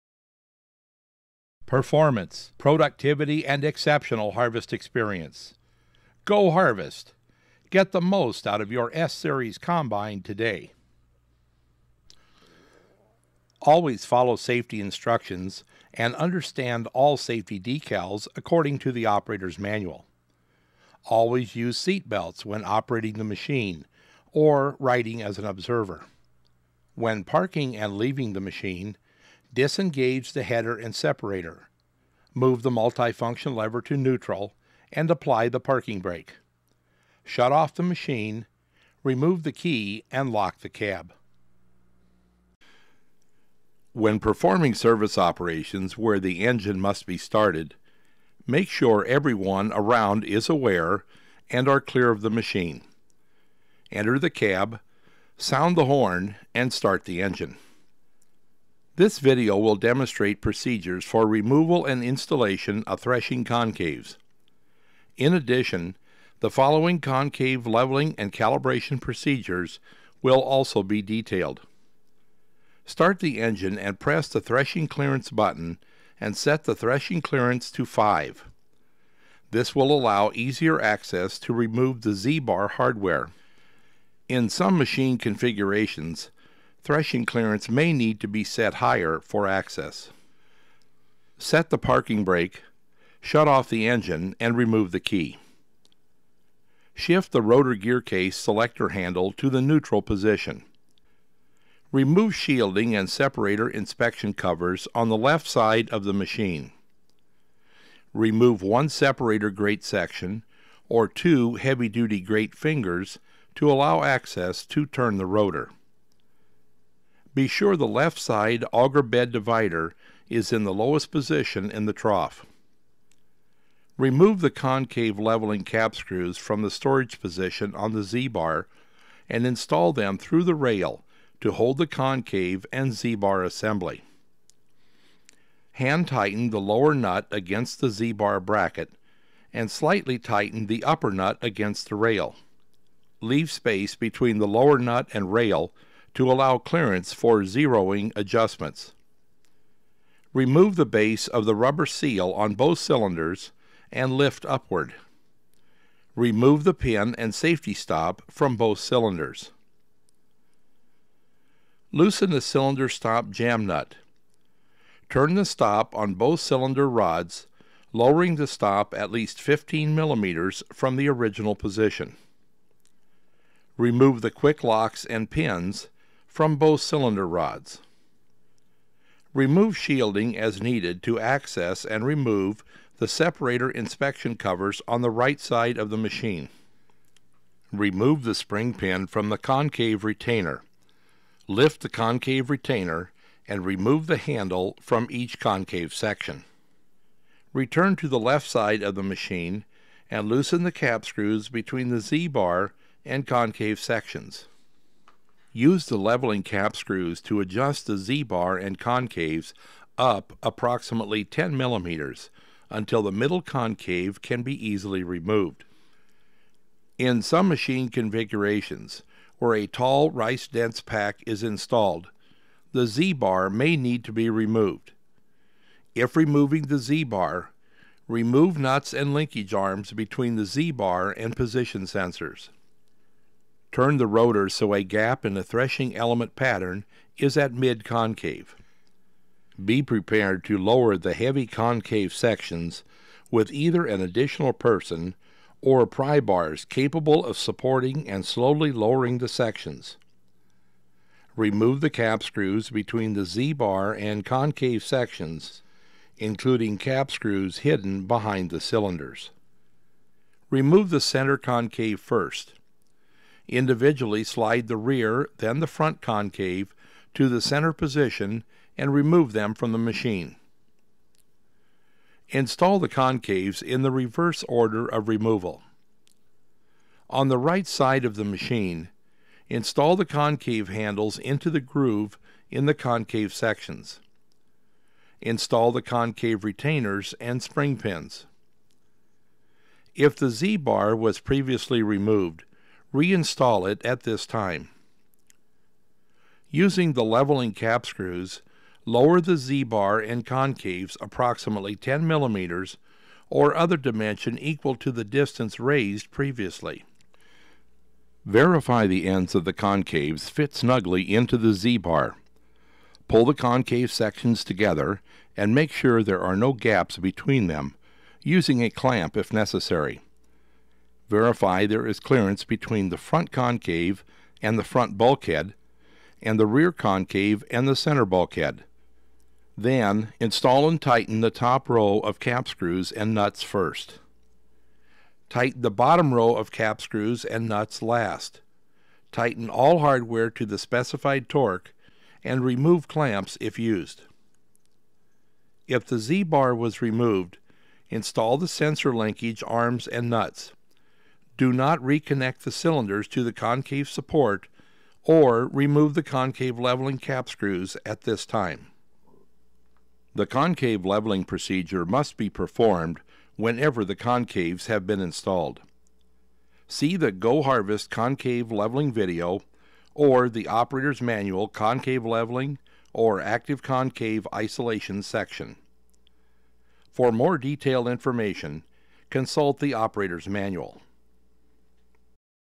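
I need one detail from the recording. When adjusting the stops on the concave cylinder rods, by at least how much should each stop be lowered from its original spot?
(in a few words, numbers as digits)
15 millimeters.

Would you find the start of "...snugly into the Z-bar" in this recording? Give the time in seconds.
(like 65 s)
310 s.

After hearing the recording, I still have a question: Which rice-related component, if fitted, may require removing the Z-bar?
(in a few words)
Tall rice dense pack.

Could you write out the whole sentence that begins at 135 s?
Hand tighten the lower nut against the Z-bar bracket and slightly tighten the upper nut against the rail.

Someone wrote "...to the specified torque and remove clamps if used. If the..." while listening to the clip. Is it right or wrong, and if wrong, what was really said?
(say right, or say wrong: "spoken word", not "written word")
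right.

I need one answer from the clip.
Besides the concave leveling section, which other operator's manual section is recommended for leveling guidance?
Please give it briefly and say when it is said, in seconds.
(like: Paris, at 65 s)
Active concave isolation, at 373 s.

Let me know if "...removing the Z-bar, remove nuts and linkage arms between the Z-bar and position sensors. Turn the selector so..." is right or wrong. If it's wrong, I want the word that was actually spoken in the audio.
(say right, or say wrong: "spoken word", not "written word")
wrong: "rotor", not "selector".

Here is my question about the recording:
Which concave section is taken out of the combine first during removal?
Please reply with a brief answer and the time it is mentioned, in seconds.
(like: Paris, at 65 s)
The center concave, at 260 s.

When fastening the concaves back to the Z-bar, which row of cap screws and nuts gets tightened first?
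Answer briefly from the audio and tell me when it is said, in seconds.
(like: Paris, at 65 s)
The top row, at 331 s.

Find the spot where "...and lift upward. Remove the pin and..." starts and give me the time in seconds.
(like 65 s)
153 s.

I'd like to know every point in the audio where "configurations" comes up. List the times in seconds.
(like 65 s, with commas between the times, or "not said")
85 s, 217 s.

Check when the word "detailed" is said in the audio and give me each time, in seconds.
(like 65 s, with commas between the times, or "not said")
71 s, 377 s.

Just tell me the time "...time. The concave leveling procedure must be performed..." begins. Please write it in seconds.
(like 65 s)
358 s.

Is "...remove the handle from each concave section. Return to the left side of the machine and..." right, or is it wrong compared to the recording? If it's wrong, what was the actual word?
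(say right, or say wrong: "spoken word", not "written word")
right.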